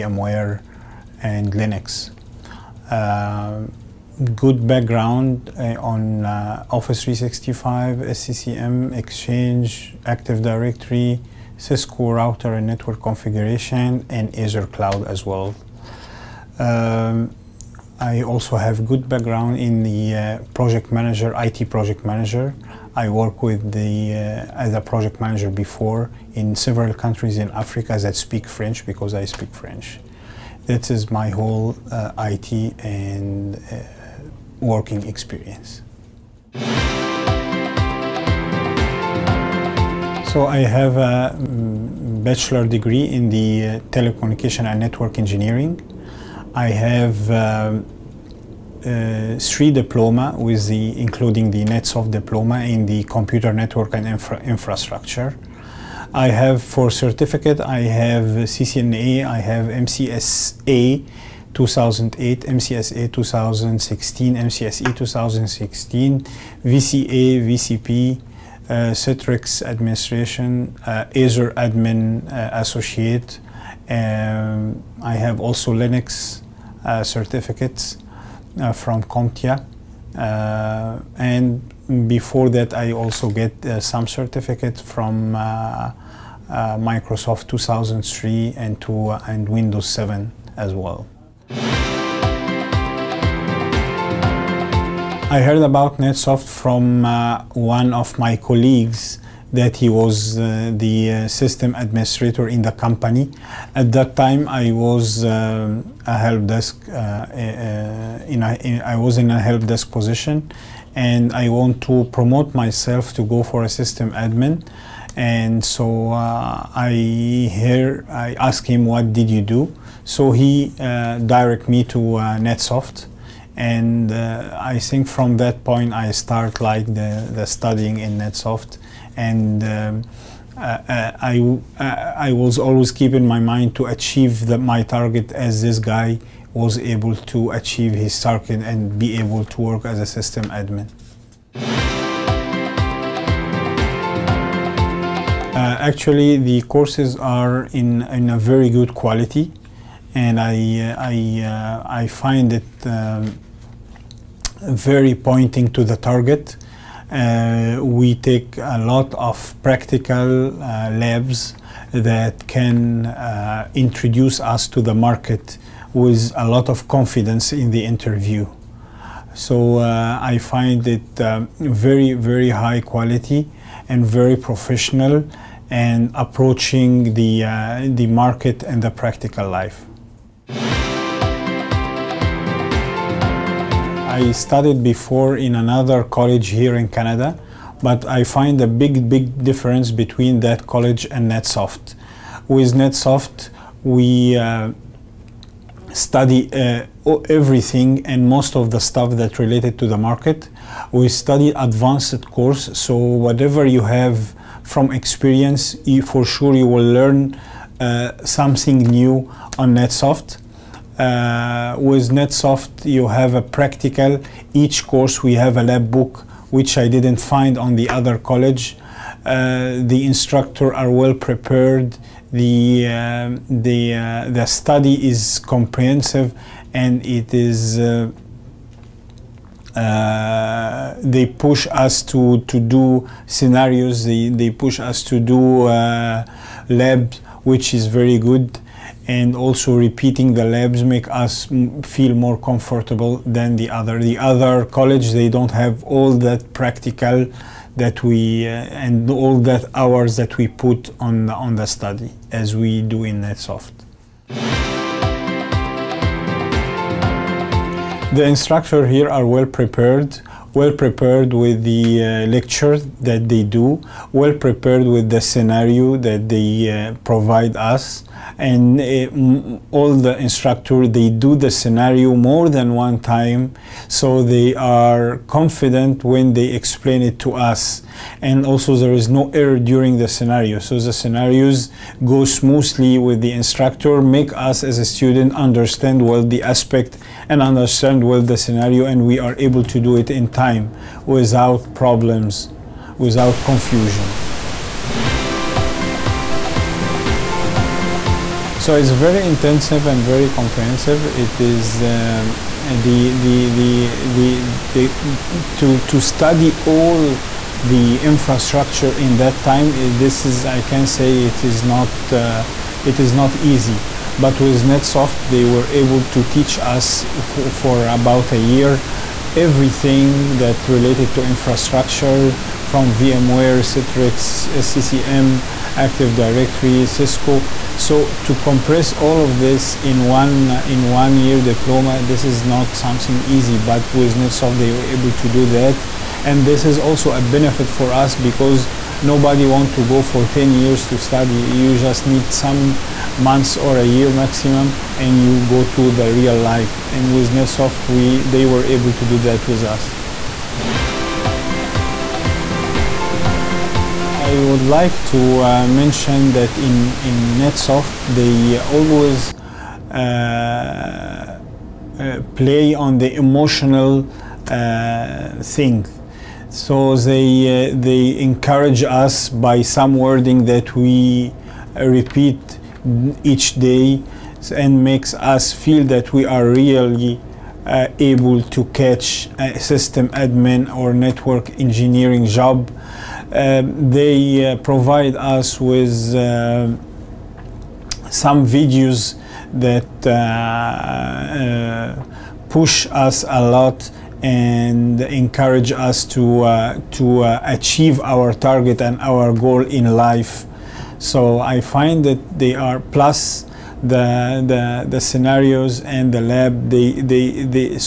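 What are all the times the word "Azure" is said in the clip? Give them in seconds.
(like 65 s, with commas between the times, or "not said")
14 s, 71 s.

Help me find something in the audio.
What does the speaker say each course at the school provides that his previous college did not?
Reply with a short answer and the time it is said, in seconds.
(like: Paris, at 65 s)
A lab book, at 215 s.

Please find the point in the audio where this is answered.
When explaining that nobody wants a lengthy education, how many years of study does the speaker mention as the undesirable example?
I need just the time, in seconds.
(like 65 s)
340 s.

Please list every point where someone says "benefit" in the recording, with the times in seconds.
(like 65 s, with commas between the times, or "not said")
337 s.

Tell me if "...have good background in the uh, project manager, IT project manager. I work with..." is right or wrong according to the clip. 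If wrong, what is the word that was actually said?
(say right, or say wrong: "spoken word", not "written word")
right.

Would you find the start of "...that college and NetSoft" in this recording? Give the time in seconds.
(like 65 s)
190 s.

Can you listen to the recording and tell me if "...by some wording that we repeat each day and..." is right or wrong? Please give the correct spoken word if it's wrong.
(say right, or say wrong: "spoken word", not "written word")
right.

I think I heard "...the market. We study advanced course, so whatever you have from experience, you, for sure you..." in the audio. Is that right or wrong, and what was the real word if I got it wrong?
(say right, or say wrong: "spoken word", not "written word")
right.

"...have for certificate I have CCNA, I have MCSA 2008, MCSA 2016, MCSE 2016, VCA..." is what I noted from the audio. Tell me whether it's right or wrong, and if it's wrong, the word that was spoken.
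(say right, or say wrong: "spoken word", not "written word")
right.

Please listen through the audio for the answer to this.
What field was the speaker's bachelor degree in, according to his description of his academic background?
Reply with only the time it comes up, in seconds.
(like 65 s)
43 s.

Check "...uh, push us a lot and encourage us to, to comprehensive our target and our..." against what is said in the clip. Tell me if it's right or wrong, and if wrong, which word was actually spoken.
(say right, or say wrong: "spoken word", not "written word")
wrong: "achieve", not "comprehensive".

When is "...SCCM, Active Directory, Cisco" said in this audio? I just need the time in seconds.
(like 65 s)
324 s.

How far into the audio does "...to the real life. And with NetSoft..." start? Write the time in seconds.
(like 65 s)
345 s.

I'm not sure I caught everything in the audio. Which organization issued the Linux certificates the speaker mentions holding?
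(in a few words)
CompTIA.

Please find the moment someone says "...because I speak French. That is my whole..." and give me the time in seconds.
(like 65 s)
28 s.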